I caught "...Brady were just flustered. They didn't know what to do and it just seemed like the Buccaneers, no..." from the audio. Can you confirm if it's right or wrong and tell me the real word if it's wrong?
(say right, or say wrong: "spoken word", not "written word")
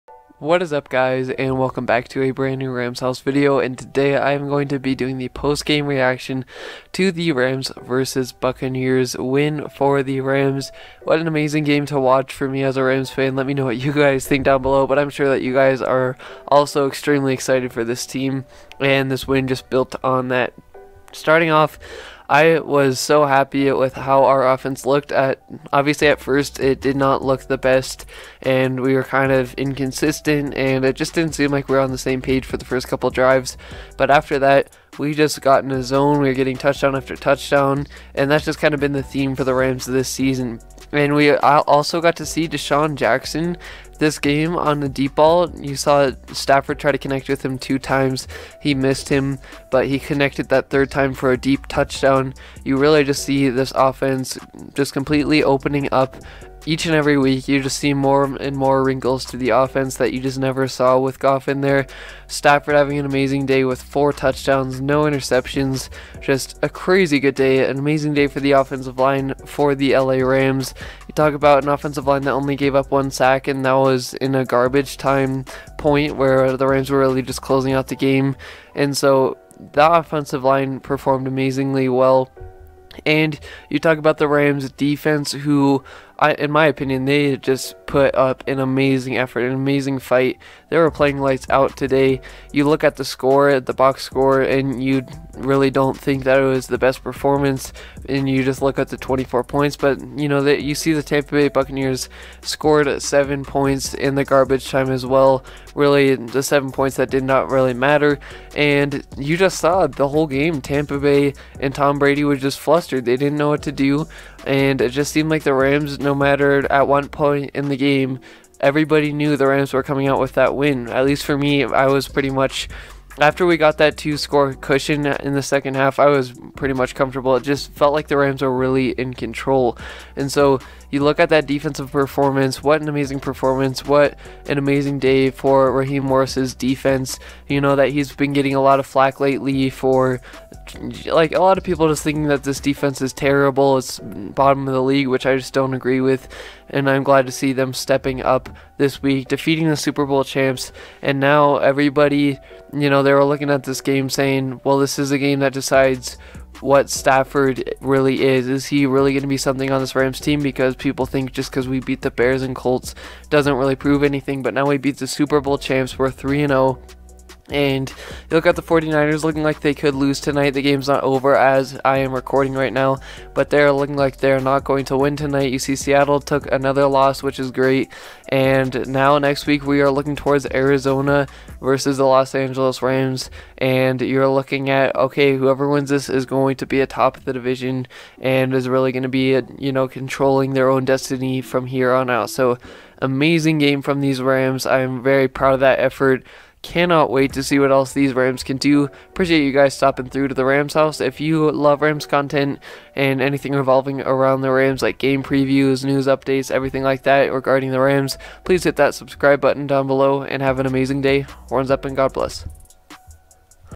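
wrong: "Rams", not "Buccaneers".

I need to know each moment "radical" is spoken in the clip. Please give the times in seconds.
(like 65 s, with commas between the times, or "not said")
not said.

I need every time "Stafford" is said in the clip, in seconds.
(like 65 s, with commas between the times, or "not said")
46 s, 62 s, 156 s.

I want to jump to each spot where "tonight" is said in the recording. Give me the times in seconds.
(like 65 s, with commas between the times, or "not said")
170 s, 175 s.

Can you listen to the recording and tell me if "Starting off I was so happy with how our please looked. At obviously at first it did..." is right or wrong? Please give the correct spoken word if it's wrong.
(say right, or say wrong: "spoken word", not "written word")
wrong: "offense", not "please".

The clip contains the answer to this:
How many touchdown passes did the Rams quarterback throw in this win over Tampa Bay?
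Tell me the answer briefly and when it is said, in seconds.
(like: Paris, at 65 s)
4, at 63 s.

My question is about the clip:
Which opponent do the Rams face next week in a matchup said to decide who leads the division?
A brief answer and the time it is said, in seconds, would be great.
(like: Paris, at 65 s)
Arizona, at 180 s.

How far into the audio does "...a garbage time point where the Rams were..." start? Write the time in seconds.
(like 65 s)
74 s.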